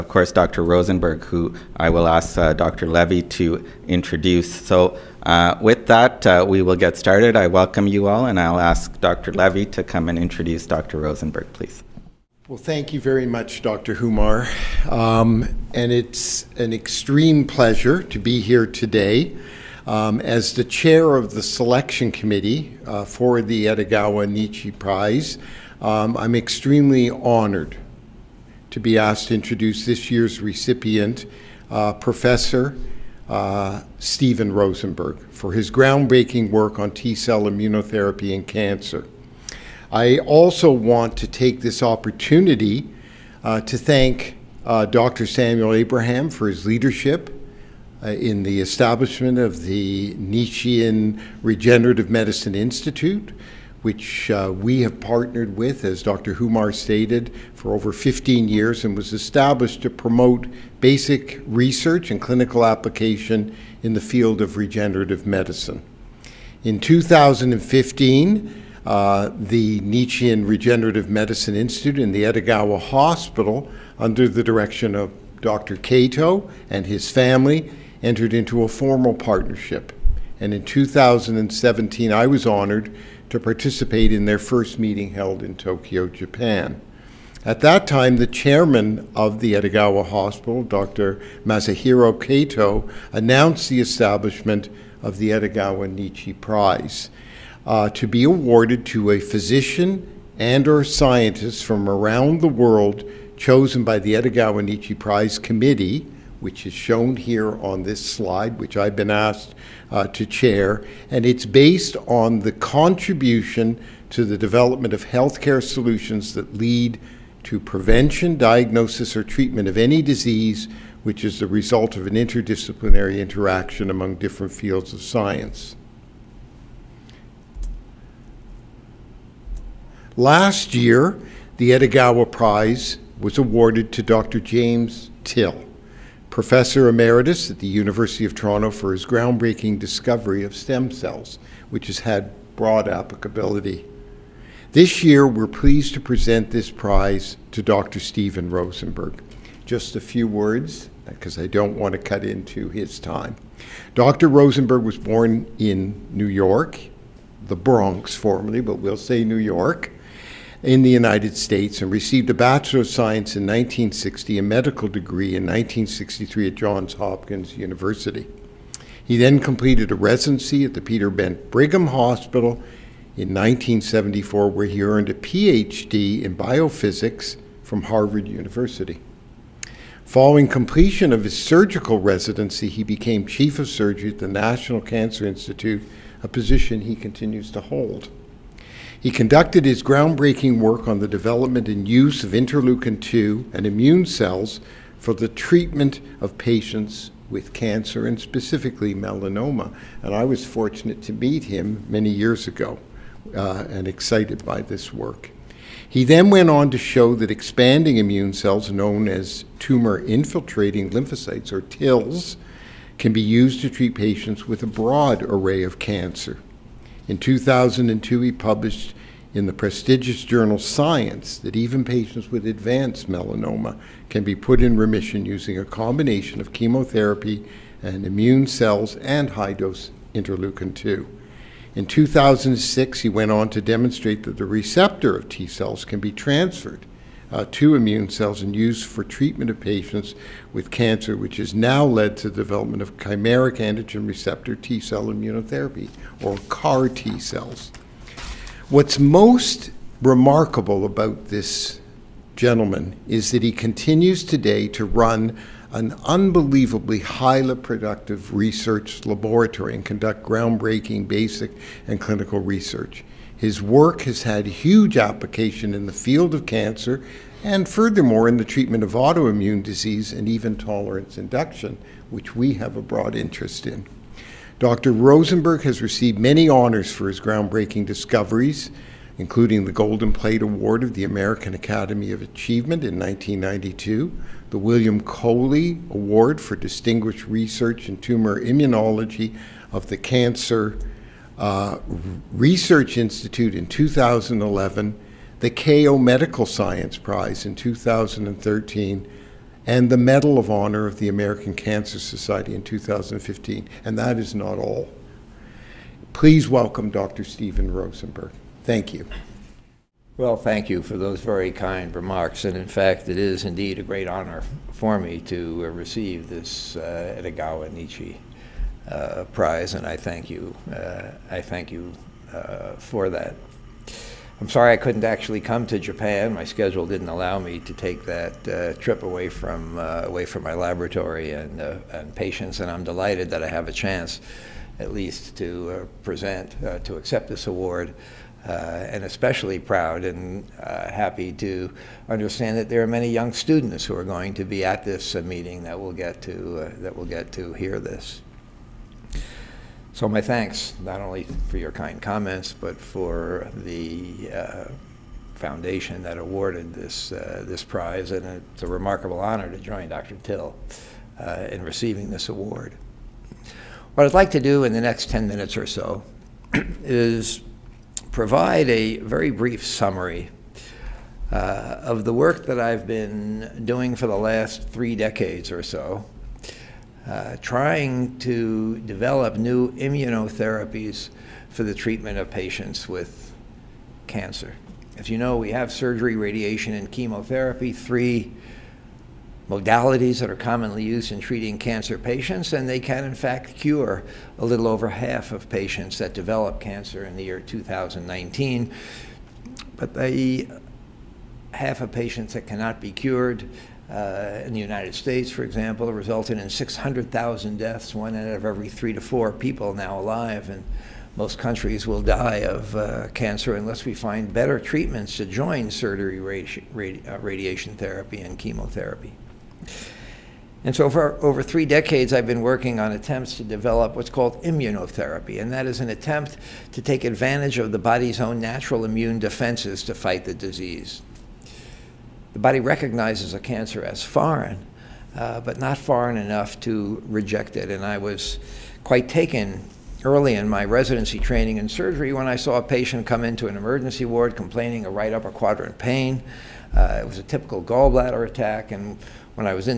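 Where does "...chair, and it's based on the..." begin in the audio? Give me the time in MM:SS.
01:50.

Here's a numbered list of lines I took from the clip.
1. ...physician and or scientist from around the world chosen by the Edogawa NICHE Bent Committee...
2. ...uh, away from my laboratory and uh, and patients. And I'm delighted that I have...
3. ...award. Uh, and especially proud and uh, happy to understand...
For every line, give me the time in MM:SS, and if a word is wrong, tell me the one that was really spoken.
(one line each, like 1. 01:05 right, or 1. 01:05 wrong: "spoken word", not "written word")
1. 01:39 wrong: "Prize", not "Bent"
2. 05:29 right
3. 05:37 right.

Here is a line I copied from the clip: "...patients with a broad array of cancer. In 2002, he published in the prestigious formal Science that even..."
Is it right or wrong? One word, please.
wrong.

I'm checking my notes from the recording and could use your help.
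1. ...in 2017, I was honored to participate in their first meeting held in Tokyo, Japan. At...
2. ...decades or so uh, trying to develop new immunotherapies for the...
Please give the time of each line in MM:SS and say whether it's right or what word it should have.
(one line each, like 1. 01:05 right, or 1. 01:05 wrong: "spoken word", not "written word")
1. 01:20 right
2. 06:14 right.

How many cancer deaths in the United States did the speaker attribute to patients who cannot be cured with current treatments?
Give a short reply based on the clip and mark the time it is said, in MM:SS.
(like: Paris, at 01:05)
600,000, at 06:46.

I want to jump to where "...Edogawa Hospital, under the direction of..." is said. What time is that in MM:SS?
01:12.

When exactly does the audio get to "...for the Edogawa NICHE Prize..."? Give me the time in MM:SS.
00:23.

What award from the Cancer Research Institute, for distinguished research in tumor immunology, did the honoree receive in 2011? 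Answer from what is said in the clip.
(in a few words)
William Coley Award.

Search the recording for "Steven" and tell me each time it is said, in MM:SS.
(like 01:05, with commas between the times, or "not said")
00:33, 02:27, 05:07.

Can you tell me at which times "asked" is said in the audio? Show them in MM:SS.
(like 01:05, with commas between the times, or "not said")
00:28, 01:49.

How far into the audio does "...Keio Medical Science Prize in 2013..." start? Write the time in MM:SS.
04:55.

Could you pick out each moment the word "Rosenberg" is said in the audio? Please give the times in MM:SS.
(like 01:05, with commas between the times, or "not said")
00:00, 00:10, 00:34, 02:28, 02:34, 04:34, 05:07.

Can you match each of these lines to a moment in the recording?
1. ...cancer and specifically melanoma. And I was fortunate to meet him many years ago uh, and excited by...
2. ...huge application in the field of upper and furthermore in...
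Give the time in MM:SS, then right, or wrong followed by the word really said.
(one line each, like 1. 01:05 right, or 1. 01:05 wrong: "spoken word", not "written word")
1. 03:17 right
2. 04:24 wrong: "cancer", not "upper".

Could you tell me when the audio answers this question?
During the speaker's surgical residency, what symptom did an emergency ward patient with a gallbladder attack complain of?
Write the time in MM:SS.
07:24.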